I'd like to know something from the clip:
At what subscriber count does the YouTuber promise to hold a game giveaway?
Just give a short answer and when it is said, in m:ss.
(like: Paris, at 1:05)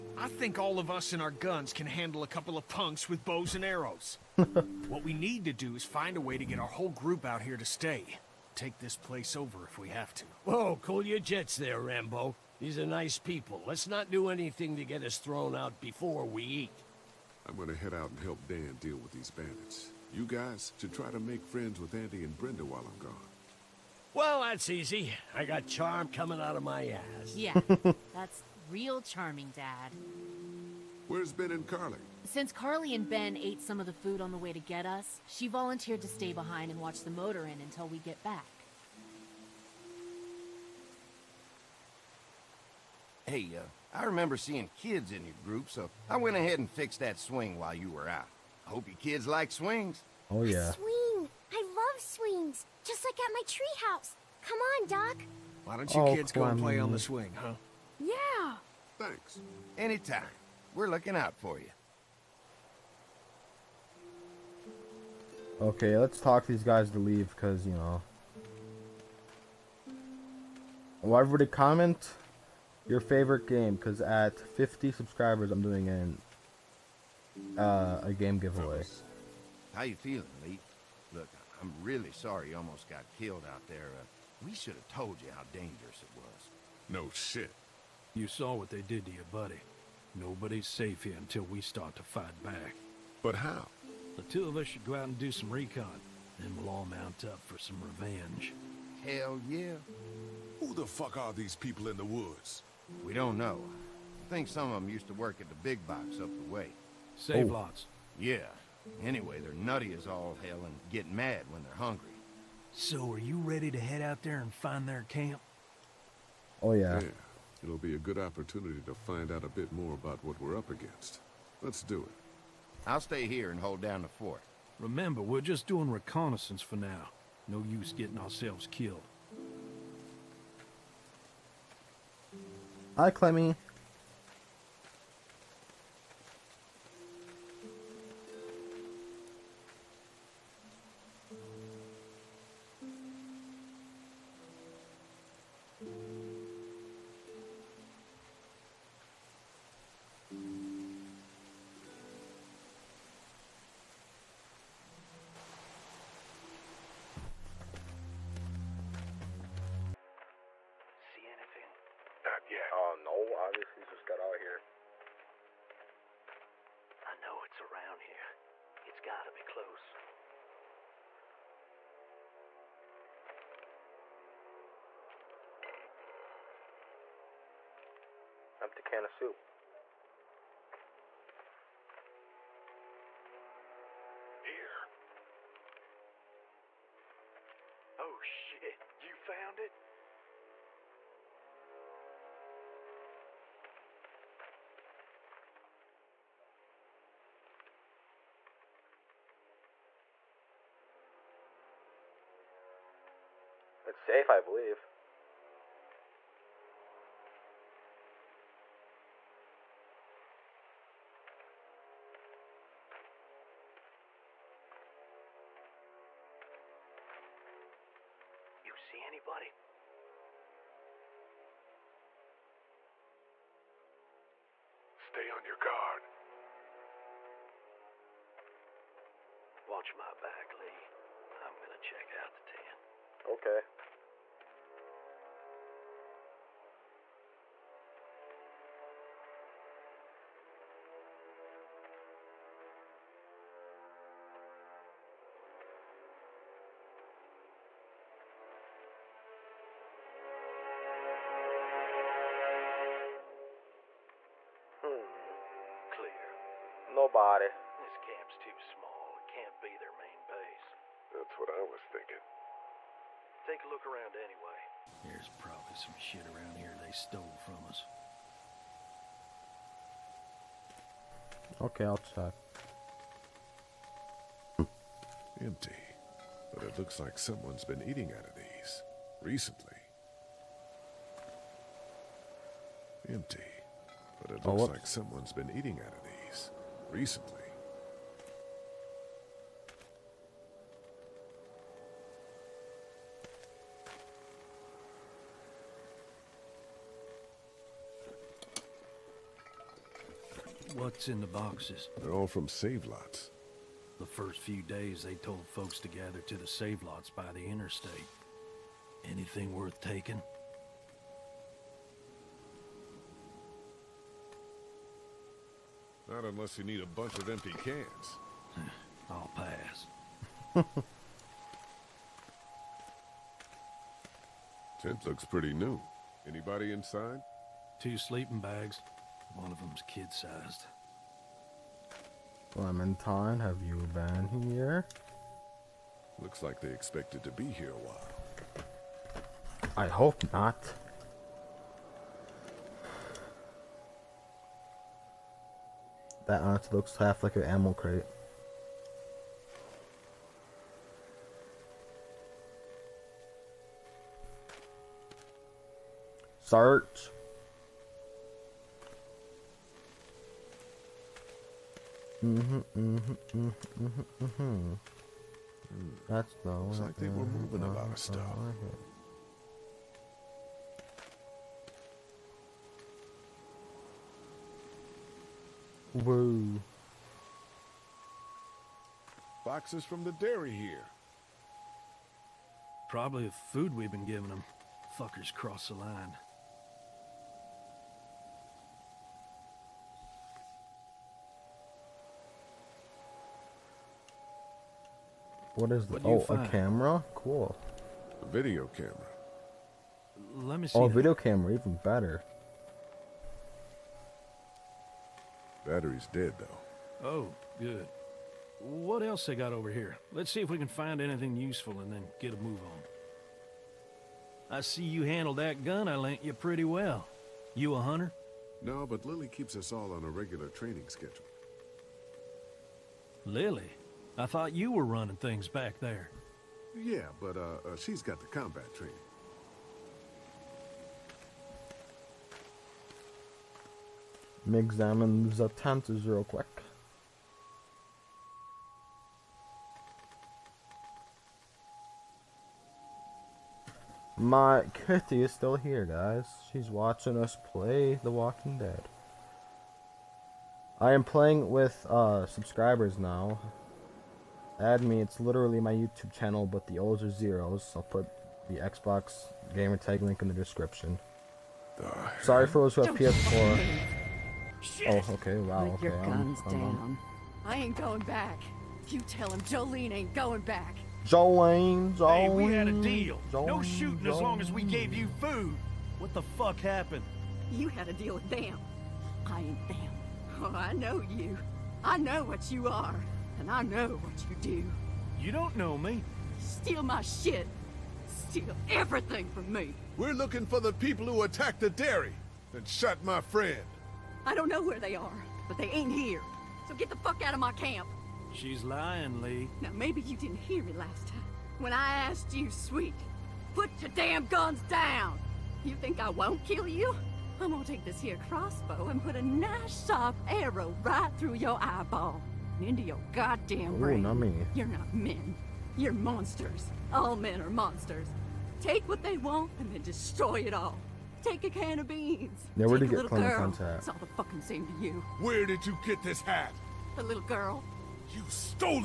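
50, at 1:14.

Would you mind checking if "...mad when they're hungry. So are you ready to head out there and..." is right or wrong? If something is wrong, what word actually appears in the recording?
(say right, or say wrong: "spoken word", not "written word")
right.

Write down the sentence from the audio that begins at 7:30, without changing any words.
I am playing with uh, subscribers now.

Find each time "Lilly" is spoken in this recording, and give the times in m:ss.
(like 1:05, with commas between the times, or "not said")
6:59, 7:03.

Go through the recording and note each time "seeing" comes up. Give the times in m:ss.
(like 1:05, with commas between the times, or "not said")
0:44.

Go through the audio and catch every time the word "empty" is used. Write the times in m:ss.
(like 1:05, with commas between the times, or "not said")
2:58, 4:35, 4:43, 5:17.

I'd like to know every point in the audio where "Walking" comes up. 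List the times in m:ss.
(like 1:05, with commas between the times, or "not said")
7:28.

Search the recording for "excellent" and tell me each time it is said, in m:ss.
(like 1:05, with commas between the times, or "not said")
not said.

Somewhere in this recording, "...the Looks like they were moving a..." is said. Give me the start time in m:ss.
6:06.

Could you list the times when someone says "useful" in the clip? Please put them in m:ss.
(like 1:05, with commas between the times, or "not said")
6:51.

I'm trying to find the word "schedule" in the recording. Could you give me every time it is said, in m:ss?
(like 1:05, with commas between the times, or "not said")
7:00.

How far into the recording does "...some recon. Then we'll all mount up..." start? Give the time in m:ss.
1:35.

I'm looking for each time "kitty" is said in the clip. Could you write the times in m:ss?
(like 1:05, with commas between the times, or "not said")
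7:24.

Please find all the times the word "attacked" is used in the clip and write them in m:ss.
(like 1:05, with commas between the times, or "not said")
8:11.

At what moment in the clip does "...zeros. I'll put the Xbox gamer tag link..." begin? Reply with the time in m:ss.
7:37.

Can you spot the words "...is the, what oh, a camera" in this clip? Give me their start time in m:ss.
6:35.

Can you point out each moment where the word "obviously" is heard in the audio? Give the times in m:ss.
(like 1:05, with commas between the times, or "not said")
2:43.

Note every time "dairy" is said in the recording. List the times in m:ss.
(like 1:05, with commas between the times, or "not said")
6:20, 8:11.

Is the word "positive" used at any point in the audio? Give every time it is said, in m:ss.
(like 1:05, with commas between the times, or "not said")
not said.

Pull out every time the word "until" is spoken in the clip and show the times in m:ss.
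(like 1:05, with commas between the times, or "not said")
0:37, 1:31.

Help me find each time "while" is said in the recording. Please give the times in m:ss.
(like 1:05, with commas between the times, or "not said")
0:22, 0:47, 5:37.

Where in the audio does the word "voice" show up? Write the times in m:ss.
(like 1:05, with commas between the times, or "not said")
not said.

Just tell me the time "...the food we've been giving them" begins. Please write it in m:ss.
6:23.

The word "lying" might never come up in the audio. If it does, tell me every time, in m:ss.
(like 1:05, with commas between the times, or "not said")
8:18.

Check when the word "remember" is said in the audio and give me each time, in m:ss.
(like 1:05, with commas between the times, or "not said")
0:44, 2:04.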